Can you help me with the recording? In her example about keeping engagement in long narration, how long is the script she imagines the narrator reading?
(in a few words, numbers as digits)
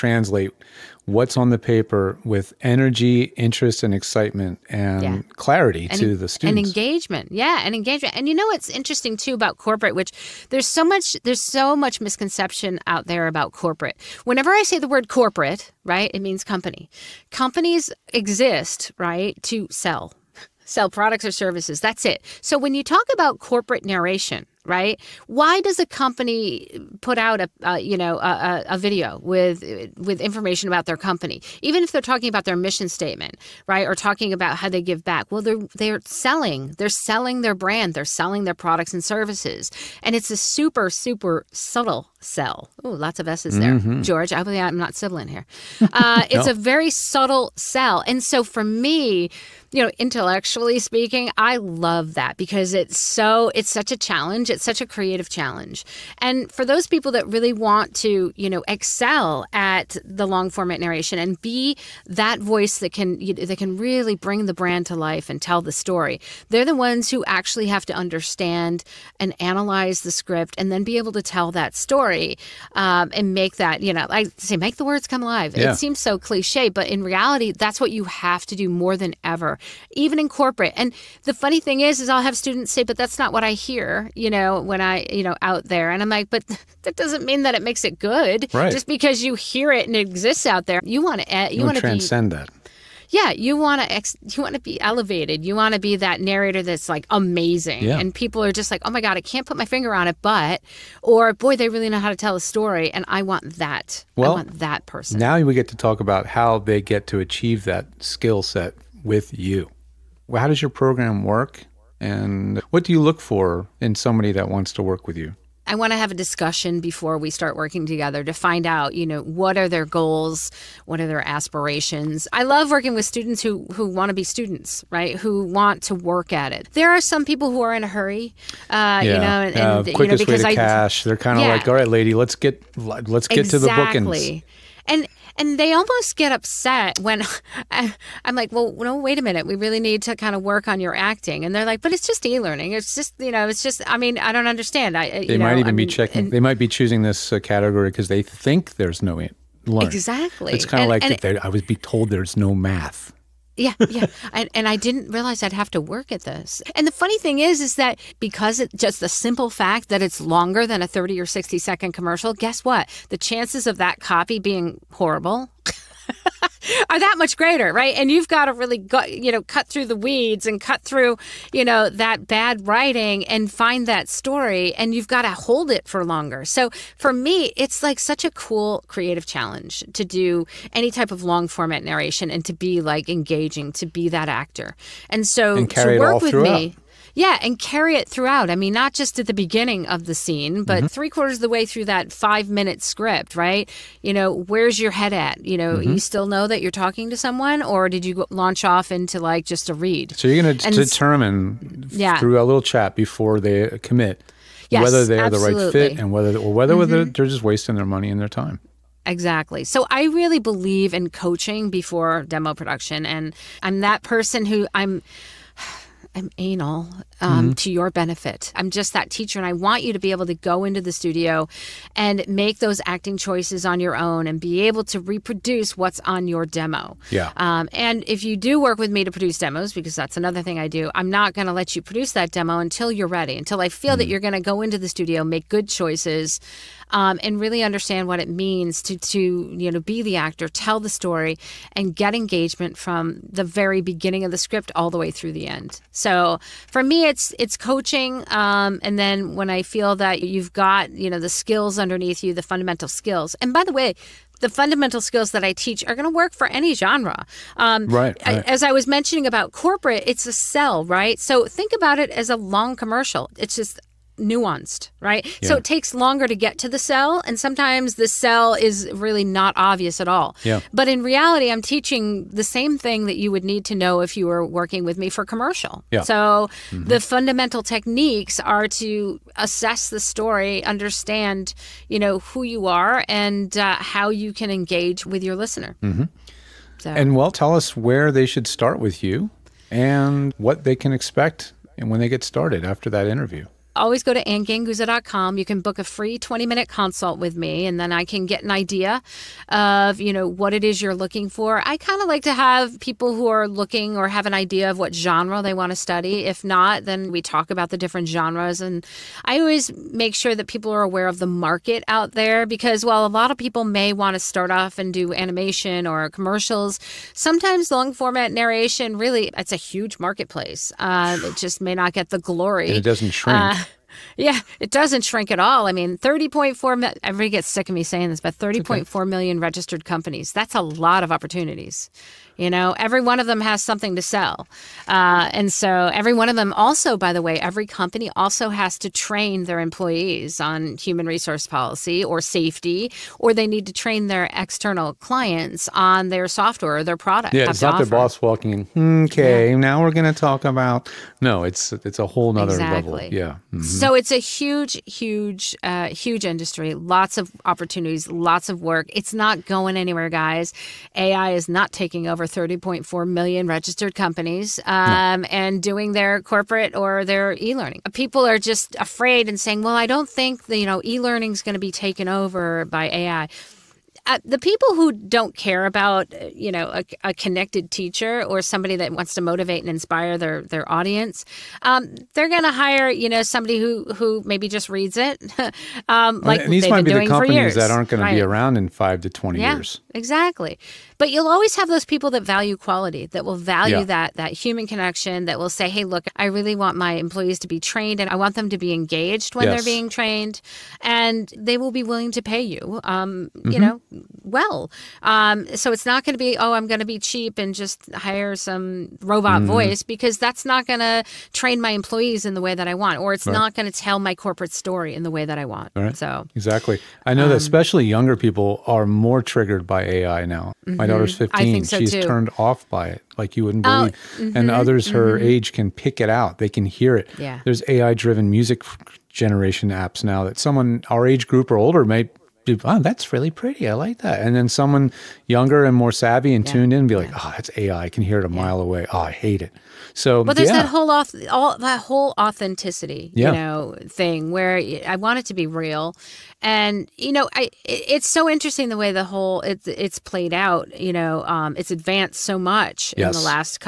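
5 minutes.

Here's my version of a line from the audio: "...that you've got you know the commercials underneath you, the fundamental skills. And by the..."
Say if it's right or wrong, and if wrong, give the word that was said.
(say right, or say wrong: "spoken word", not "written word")
wrong: "skills", not "commercials".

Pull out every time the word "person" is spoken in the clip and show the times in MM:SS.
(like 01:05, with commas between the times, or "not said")
01:44, 03:34.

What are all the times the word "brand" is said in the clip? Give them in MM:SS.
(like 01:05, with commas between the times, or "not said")
00:37, 01:04.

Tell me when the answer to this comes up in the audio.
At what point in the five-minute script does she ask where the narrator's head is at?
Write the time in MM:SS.
03:10.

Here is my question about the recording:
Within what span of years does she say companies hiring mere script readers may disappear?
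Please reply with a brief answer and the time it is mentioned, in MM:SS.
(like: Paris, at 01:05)
5 to 20 years, at 06:28.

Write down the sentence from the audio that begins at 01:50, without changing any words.
Well, how does your program work, and what do you look for in somebody that wants to work with you?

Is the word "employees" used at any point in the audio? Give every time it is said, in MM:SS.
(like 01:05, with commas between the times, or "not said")
05:39, 06:36, 06:51.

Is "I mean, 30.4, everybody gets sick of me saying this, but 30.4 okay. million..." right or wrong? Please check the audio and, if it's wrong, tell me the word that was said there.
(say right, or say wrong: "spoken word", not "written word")
right.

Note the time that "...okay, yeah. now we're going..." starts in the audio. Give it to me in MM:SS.
05:49.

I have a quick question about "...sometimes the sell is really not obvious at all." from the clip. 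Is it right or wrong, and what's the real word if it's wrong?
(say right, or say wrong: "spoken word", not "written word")
right.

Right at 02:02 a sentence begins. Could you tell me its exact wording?
I love working with students who who want to be students, right?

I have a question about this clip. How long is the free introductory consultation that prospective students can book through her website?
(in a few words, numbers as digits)
20 minutes.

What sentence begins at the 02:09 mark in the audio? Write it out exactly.
you know, and, uh, you know, because way to I, cash.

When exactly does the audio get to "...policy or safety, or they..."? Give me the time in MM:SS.
05:41.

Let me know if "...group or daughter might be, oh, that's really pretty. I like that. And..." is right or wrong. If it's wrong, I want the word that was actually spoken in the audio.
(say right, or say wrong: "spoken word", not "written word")
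wrong: "older", not "daughter".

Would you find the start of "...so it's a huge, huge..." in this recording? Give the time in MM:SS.
05:53.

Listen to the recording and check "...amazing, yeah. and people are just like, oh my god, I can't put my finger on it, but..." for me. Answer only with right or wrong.
right.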